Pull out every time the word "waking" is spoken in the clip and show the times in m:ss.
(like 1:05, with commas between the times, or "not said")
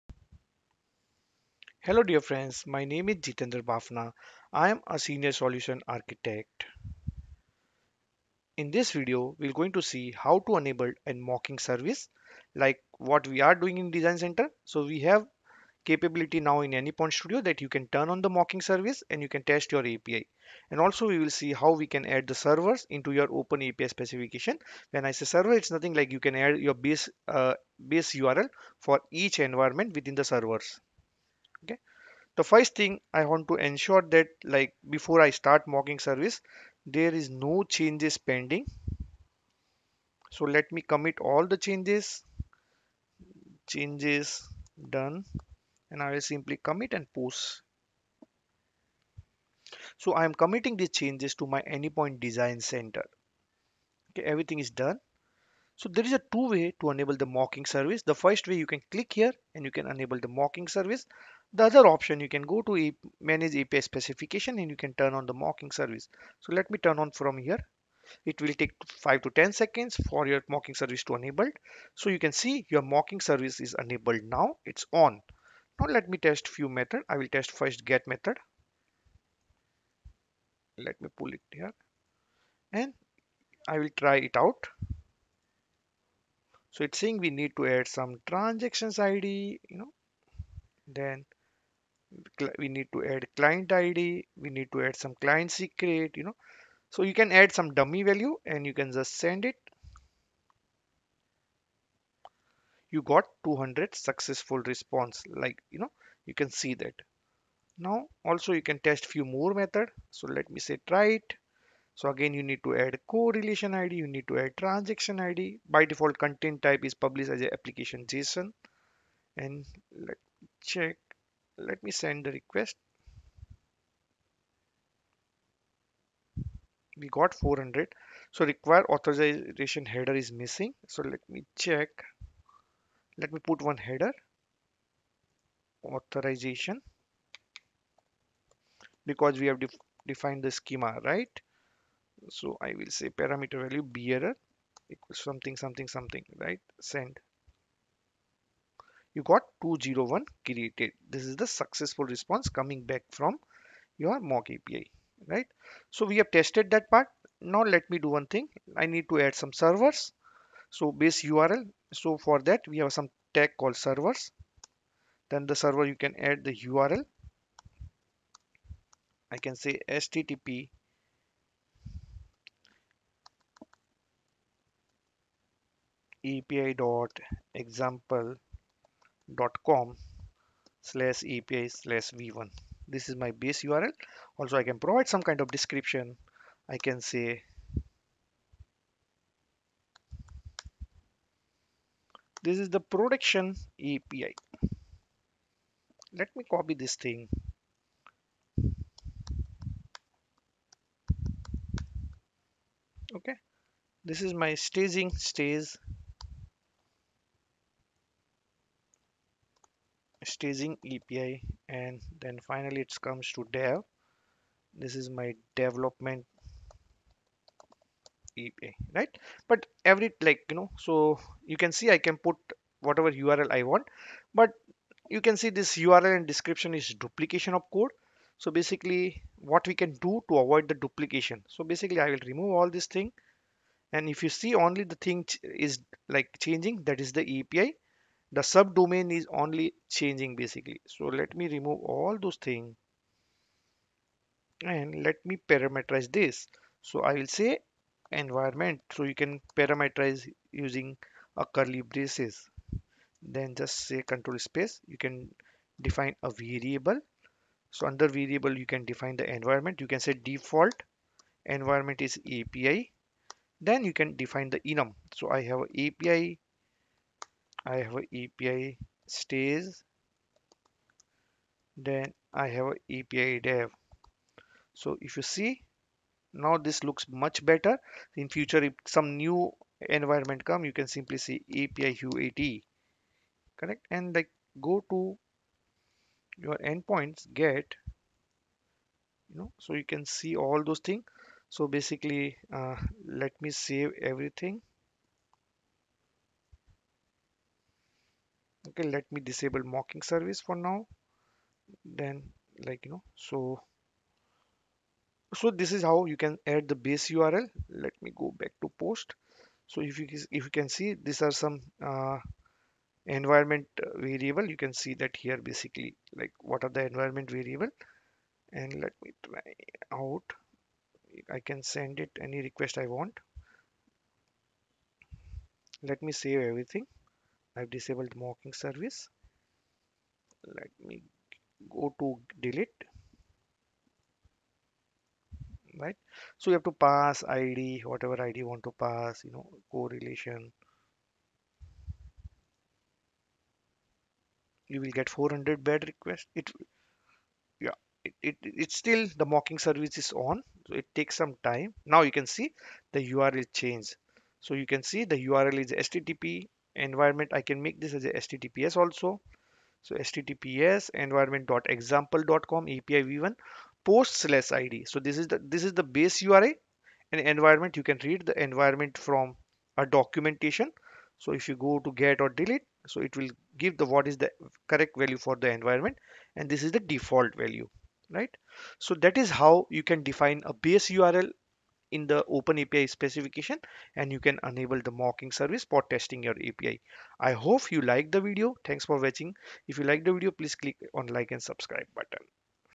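not said.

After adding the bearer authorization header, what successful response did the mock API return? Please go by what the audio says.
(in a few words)
201 Created.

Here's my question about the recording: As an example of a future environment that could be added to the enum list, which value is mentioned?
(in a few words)
API UAT.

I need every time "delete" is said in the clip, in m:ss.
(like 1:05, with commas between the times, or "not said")
5:32, 6:12.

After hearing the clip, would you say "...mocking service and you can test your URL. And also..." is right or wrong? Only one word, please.
wrong.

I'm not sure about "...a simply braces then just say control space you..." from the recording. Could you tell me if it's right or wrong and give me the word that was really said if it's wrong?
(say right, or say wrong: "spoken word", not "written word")
wrong: "curly", not "simply".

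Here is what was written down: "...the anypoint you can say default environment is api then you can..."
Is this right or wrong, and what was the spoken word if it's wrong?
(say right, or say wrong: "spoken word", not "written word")
wrong: "environment", not "anypoint".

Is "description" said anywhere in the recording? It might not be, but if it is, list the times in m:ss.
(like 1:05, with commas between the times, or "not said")
3:05, 3:46.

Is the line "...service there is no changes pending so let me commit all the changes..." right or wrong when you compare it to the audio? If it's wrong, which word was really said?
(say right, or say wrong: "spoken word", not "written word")
right.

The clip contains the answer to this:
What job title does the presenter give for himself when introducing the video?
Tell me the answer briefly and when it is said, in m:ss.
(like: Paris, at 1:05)
Senior solution architect, at 0:04.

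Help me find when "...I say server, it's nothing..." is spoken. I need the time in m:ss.
0:25.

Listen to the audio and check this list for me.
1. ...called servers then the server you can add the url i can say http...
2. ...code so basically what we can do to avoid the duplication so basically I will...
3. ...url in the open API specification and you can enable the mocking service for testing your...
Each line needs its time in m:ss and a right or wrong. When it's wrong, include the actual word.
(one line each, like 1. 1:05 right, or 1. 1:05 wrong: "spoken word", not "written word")
1. 2:43 right
2. 3:47 right
3. 6:20 right.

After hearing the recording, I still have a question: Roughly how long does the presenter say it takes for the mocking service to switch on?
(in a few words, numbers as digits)
5 to 10 seconds.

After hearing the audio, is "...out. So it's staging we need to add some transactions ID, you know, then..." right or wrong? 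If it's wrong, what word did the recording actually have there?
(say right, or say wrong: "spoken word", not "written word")
wrong: "saying", not "staging".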